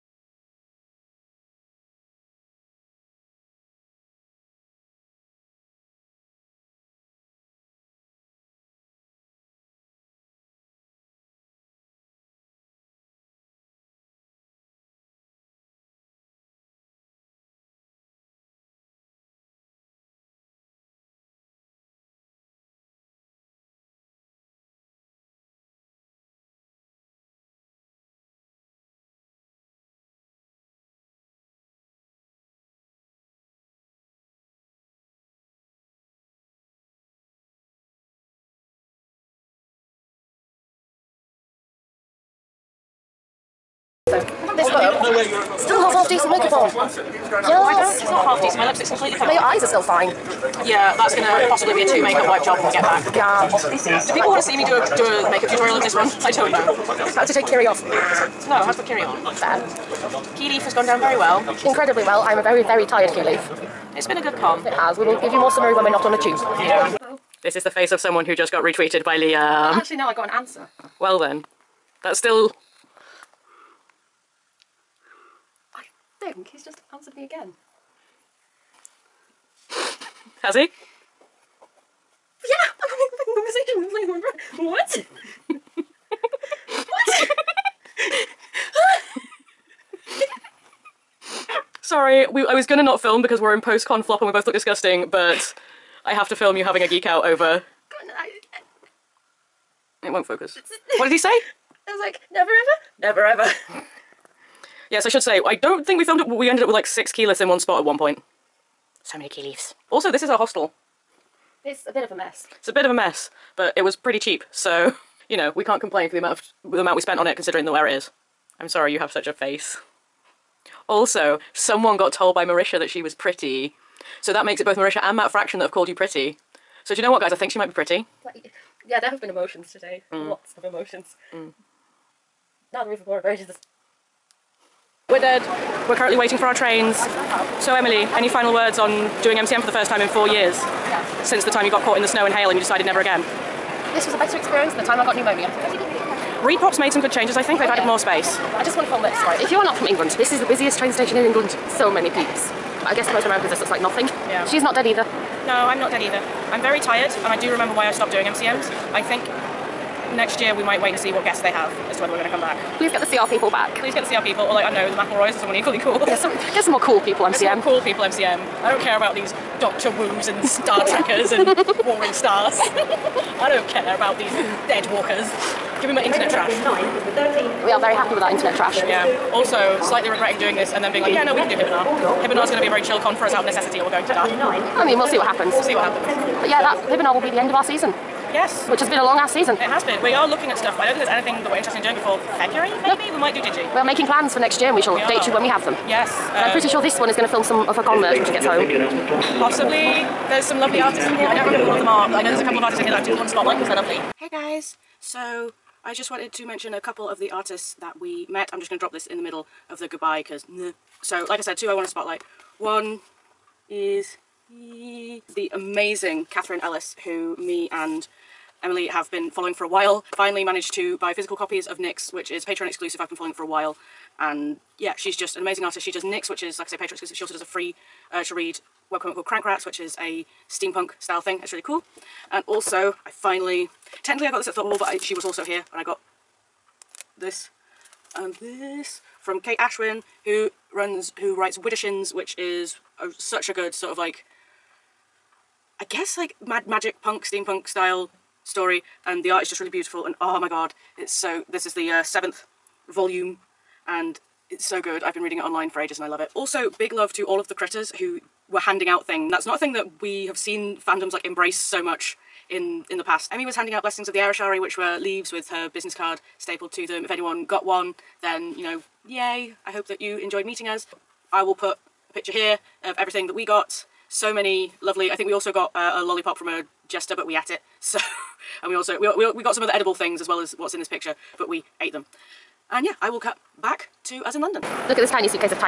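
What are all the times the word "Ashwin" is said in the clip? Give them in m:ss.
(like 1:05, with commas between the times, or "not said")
3:59.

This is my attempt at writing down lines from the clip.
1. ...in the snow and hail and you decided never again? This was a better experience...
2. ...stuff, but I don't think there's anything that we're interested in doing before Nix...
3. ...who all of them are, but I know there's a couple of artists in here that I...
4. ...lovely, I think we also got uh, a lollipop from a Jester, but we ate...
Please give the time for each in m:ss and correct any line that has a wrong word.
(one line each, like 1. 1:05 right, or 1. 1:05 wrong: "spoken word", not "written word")
1. 2:21 right
2. 3:10 wrong: "February", not "Nix"
3. 3:21 right
4. 4:34 right.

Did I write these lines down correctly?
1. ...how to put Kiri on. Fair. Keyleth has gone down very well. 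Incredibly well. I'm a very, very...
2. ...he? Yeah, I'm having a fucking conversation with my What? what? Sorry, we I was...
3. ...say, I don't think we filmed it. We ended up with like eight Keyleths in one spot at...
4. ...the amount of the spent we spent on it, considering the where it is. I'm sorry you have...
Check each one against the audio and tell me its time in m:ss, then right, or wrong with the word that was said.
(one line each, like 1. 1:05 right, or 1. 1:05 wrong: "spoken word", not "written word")
1. 0:58 right
2. 1:20 right
3. 1:45 wrong: "six", not "eight"
4. 1:56 wrong: "amount", not "spent".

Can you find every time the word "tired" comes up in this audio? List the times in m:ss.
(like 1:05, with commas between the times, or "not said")
1:02, 2:36.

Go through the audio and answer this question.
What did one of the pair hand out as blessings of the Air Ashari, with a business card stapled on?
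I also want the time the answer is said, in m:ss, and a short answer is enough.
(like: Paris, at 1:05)
Leaves, at 4:24.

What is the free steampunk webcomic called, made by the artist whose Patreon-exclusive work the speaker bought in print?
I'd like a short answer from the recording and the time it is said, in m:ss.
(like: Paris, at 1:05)
Crank Rats, at 3:49.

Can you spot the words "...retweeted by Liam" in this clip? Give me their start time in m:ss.
1:08.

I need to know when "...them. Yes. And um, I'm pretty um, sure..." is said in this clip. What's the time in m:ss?
3:15.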